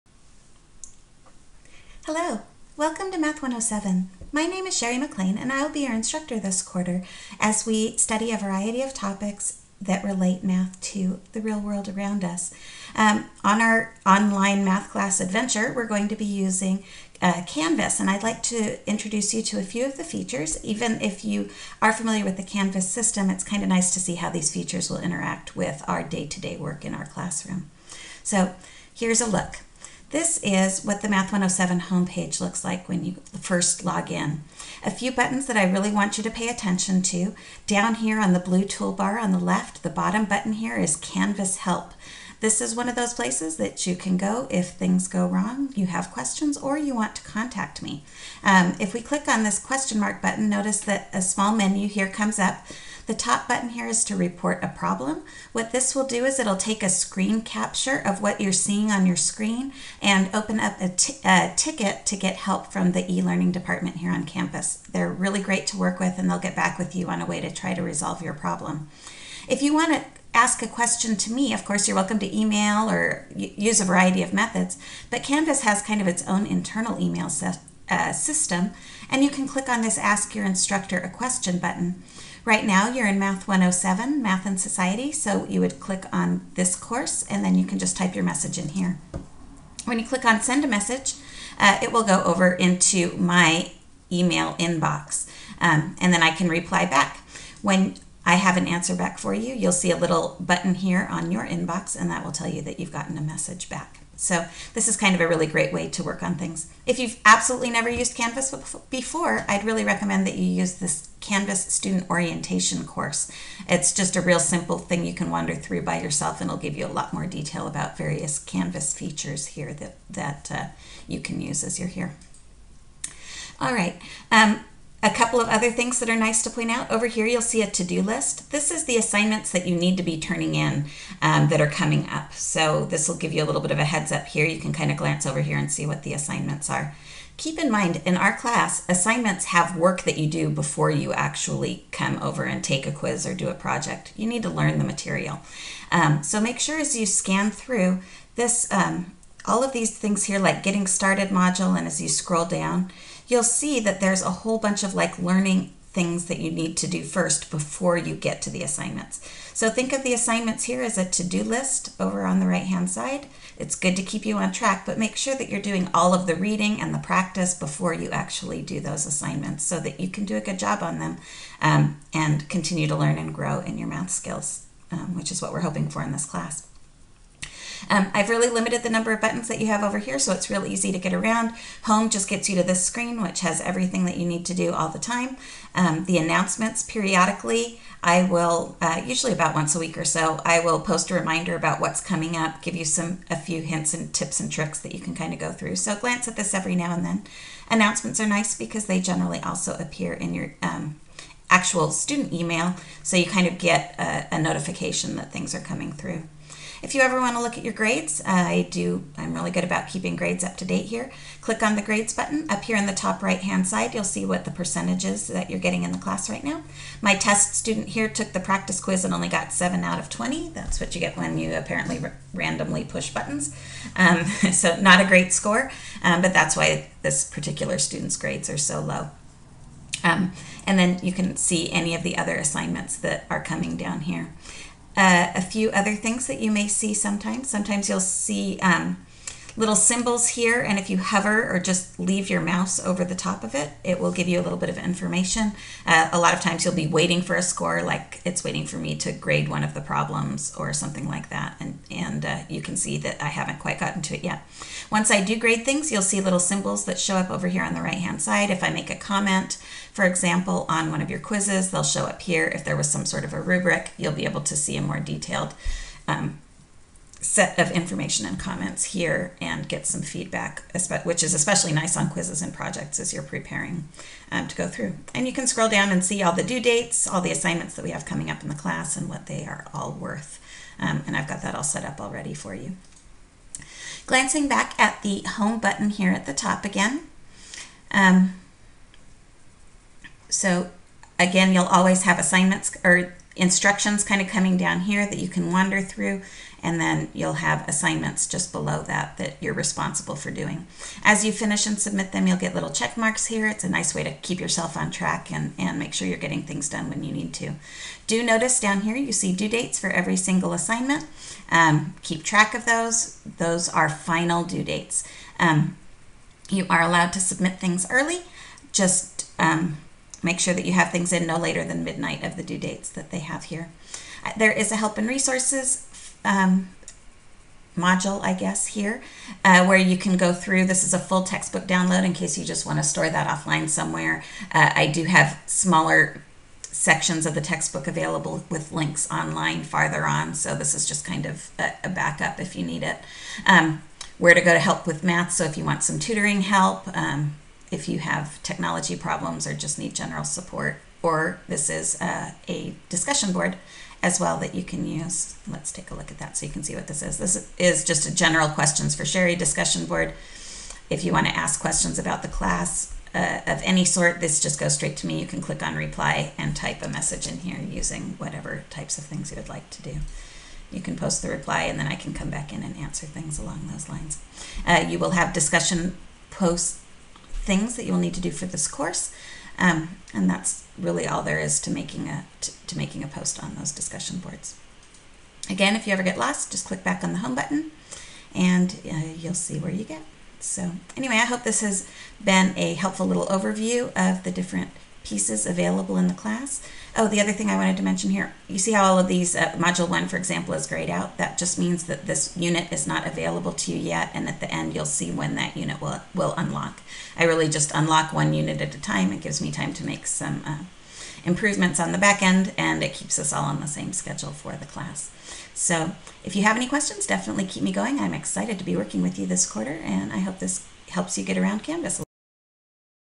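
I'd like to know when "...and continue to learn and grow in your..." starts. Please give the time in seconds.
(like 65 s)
172 s.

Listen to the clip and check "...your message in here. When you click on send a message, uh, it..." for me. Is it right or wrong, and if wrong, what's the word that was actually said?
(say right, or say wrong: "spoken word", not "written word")
right.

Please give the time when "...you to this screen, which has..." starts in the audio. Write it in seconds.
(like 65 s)
182 s.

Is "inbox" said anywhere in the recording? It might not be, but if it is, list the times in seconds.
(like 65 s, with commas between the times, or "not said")
94 s, 101 s.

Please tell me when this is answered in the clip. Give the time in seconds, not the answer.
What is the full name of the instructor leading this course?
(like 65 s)
4 s.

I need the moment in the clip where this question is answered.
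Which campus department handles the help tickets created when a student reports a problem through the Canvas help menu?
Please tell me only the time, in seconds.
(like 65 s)
63 s.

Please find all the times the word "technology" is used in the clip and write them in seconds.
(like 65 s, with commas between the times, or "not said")
348 s.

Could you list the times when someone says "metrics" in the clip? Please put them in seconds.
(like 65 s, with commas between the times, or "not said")
not said.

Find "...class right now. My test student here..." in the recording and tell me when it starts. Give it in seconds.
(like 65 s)
215 s.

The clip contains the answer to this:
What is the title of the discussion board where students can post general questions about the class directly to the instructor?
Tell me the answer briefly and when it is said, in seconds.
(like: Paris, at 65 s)
General questions for Sherry, at 358 s.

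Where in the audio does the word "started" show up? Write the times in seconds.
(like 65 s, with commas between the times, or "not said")
150 s.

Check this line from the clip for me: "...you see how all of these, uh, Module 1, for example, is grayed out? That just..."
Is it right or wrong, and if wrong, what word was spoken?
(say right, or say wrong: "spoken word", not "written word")
right.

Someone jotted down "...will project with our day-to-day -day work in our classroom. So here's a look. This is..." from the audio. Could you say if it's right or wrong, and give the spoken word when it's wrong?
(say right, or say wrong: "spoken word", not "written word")
wrong: "interact", not "project".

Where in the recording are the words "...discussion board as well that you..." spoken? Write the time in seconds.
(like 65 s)
352 s.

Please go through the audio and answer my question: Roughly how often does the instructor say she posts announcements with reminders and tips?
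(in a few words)
once a week.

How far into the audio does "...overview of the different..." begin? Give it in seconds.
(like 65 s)
393 s.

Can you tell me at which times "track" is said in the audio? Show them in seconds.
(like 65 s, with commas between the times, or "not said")
164 s, 304 s, 312 s.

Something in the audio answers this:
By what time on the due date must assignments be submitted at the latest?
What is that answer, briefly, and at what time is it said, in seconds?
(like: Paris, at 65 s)
midnight, at 321 s.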